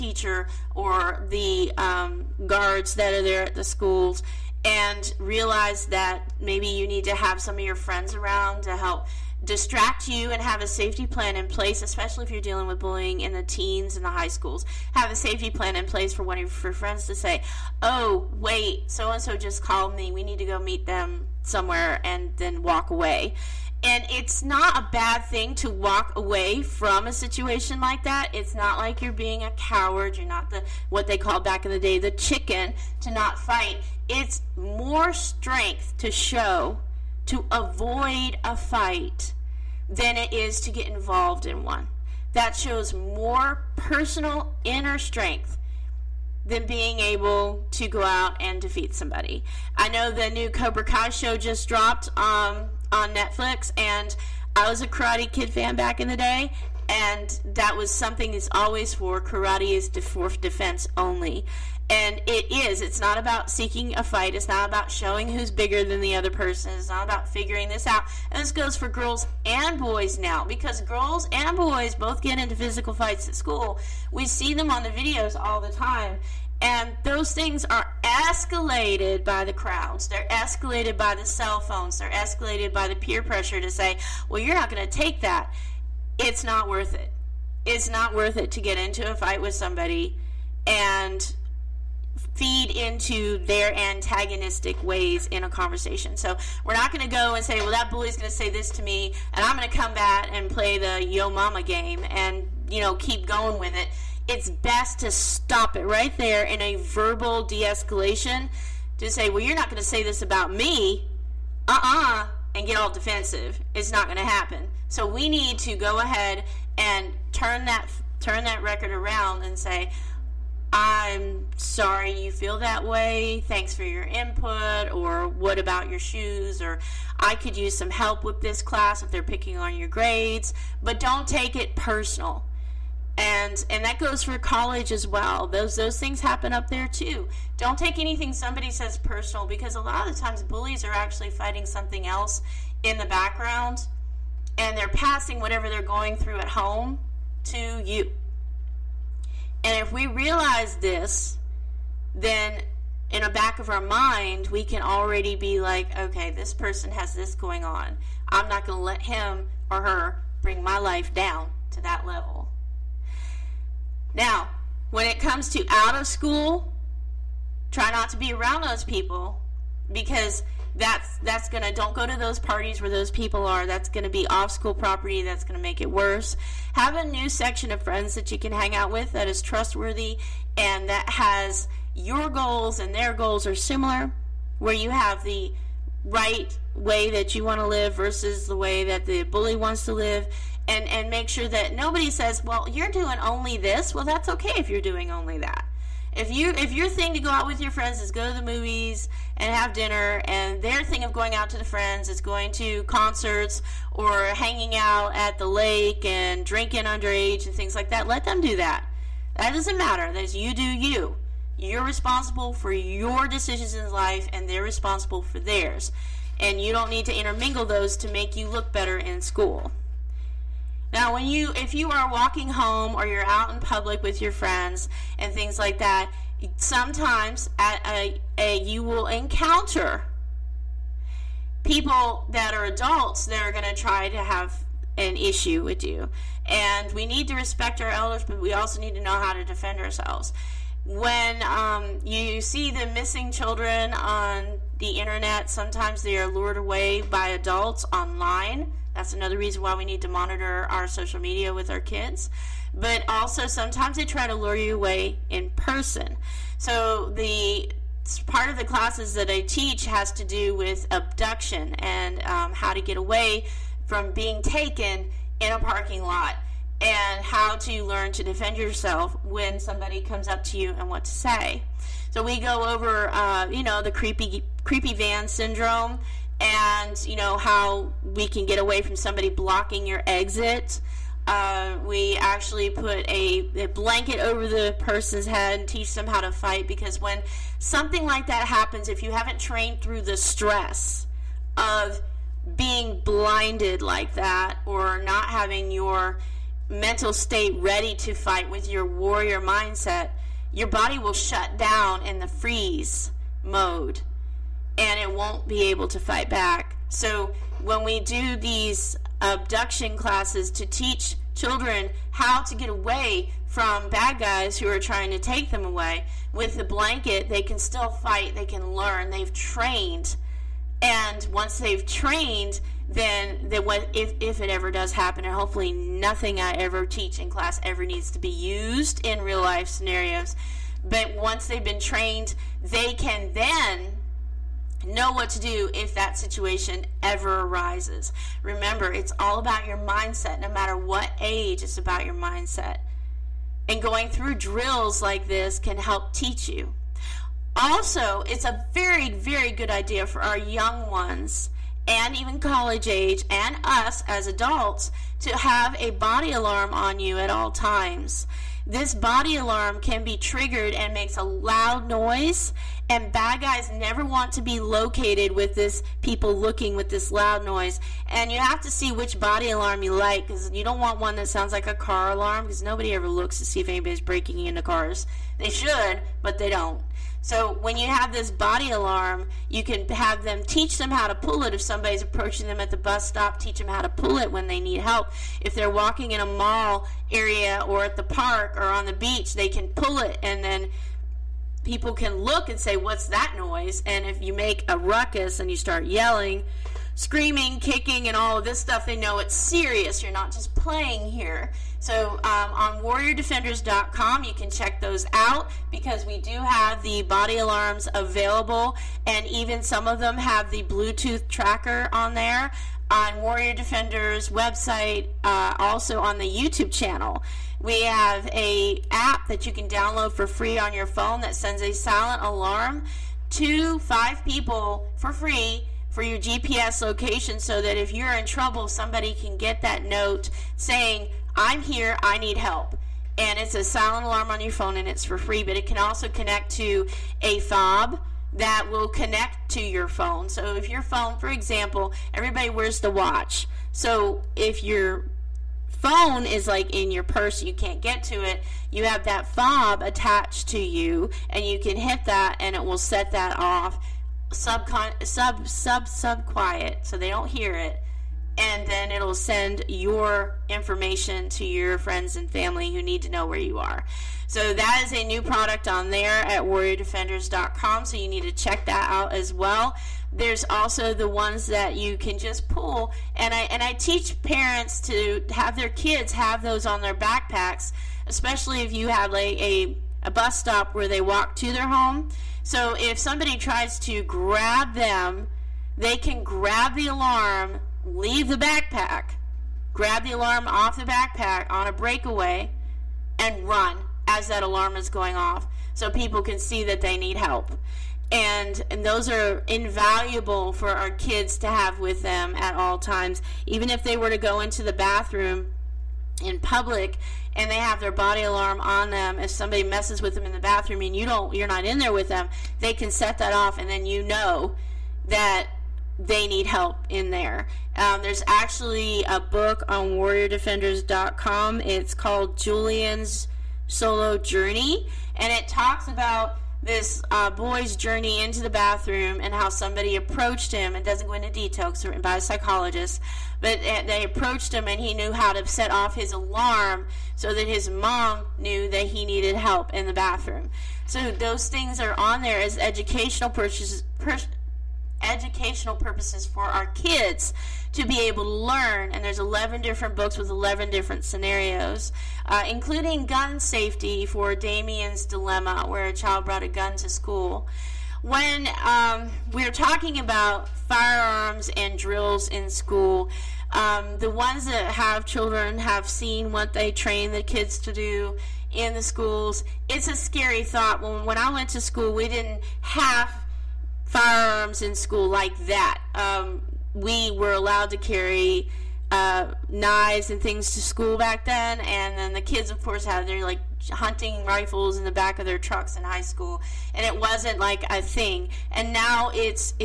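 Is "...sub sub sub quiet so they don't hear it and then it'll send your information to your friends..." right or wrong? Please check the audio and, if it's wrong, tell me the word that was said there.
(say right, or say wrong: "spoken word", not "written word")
right.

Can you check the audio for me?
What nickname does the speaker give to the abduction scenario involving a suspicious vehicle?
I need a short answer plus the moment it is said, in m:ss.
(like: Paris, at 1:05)
creepy van syndrome, at 4:34.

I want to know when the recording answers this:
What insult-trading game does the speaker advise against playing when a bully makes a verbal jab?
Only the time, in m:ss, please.
1:41.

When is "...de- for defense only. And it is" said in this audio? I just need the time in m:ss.
0:59.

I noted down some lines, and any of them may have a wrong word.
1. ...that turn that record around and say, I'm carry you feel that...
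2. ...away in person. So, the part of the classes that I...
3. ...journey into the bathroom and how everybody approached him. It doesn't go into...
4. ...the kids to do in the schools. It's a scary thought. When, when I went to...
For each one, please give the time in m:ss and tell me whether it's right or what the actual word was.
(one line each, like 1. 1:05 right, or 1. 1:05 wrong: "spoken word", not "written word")
1. 1:57 wrong: "sorry", not "carry"
2. 4:14 right
3. 8:47 wrong: "somebody", not "everybody"
4. 9:27 right.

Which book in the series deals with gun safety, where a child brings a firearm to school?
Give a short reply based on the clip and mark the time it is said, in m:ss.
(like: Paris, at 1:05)
Damien's Dilemma, at 9:14.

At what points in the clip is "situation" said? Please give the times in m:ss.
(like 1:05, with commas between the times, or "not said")
0:27, 5:36.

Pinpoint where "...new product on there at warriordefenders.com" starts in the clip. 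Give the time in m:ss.
7:45.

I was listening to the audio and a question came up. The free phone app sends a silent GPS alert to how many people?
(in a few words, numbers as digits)
5.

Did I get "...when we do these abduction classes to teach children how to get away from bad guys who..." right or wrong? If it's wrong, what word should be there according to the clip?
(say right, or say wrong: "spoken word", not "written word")
right.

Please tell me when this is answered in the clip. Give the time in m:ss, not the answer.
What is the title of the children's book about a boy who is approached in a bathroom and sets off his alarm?
8:42.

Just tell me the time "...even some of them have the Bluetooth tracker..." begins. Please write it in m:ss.
6:49.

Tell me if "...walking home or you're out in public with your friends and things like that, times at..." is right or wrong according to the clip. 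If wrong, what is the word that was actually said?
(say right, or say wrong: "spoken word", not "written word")
wrong: "sometimes", not "times".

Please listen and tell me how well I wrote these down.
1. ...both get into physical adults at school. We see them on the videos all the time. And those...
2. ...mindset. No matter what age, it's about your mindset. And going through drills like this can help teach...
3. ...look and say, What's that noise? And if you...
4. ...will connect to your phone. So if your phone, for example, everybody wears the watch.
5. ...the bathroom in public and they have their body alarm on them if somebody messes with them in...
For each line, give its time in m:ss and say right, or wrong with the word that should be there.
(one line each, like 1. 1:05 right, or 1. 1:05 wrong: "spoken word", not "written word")
1. 1:11 wrong: "fights", not "adults"
2. 5:39 right
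3. 6:32 right
4. 7:18 right
5. 8:24 right.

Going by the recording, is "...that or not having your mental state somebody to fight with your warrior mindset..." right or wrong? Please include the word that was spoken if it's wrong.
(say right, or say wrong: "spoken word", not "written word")
wrong: "ready", not "somebody".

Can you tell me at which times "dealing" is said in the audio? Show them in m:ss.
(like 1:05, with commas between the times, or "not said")
0:12.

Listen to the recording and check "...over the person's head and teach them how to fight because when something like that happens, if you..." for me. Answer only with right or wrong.
right.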